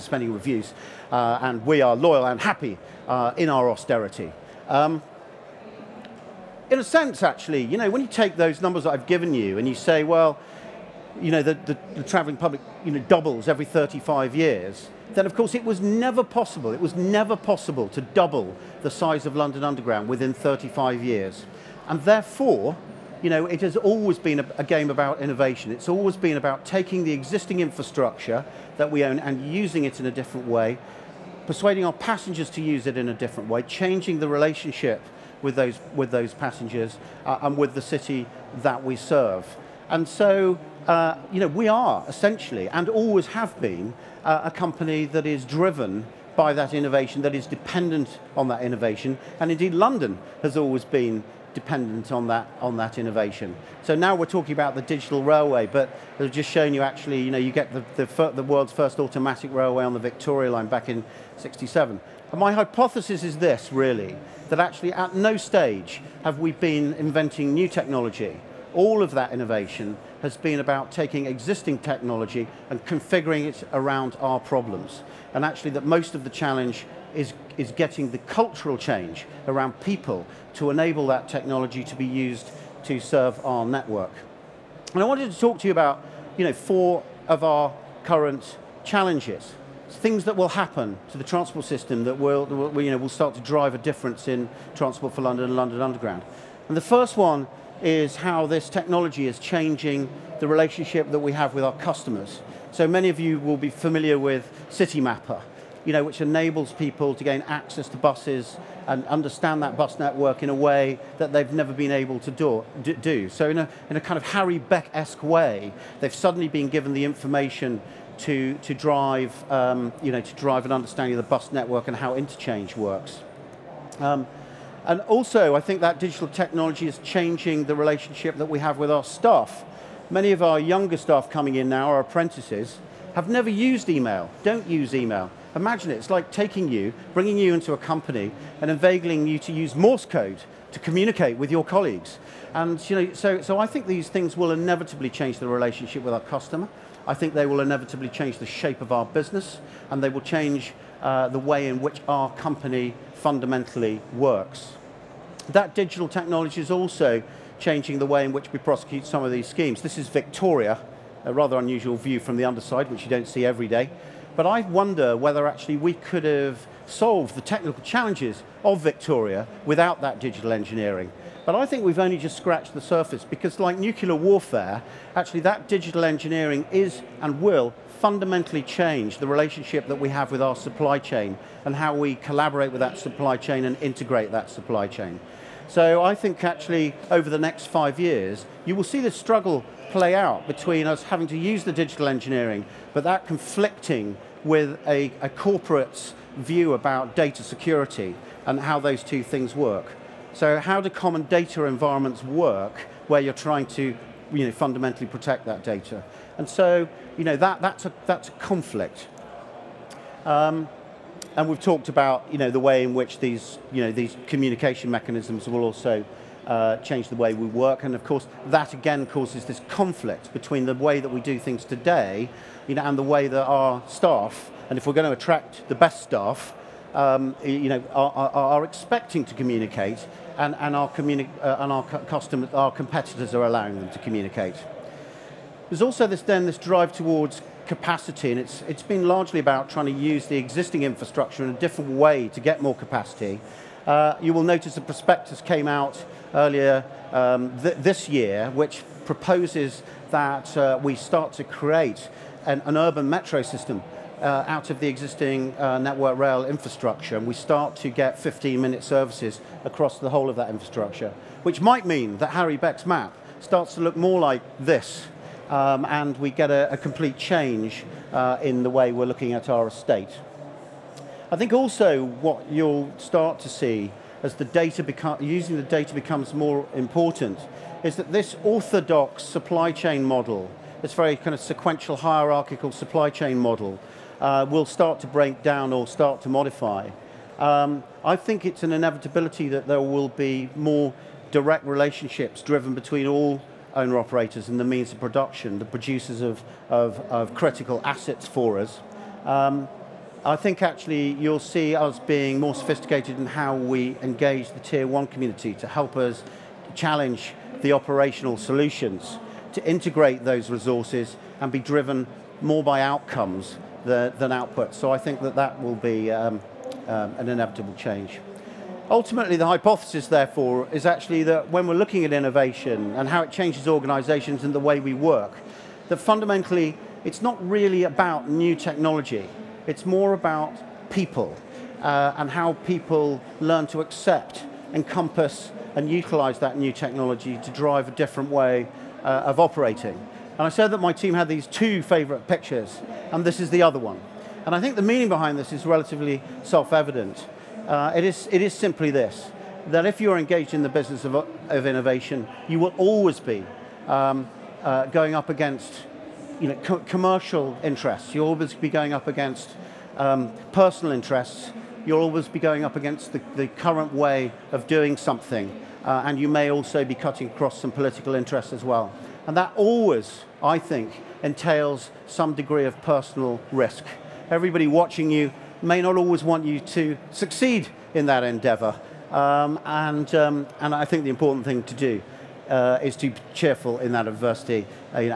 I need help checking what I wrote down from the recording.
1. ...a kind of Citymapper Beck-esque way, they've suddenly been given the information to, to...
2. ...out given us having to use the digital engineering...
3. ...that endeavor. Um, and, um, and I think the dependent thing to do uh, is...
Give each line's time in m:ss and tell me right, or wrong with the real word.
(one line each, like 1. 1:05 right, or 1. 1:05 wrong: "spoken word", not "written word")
1. 1:53 wrong: "Harry", not "Citymapper"
2. 3:10 wrong: "between", not "given"
3. 6:18 wrong: "important", not "dependent".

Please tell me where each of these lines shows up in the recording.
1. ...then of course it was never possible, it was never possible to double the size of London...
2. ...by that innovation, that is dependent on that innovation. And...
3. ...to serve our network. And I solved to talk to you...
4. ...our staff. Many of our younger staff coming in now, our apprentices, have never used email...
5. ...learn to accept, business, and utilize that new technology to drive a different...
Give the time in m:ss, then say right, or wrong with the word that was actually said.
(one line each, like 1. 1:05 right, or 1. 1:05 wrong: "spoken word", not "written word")
1. 0:15 right
2. 0:46 right
3. 1:22 wrong: "wanted", not "solved"
4. 2:08 right
5. 5:33 wrong: "encompass", not "business".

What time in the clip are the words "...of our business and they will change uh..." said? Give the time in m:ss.
2:28.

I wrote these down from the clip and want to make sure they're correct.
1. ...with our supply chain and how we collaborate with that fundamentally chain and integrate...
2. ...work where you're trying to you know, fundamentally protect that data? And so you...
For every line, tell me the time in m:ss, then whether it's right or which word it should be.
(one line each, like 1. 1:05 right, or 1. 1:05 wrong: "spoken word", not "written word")
1. 3:00 wrong: "supply", not "fundamentally"
2. 3:22 right.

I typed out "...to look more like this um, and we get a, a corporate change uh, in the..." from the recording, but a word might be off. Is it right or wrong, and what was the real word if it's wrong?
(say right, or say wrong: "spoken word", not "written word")
wrong: "complete", not "corporate".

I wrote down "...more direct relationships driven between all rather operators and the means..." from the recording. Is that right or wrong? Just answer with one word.
wrong.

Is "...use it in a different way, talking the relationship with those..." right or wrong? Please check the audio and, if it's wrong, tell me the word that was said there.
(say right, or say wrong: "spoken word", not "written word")
wrong: "changing", not "talking".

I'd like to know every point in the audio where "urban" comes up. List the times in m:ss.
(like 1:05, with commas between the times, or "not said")
4:12.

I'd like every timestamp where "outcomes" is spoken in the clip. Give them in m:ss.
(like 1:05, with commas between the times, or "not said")
5:12.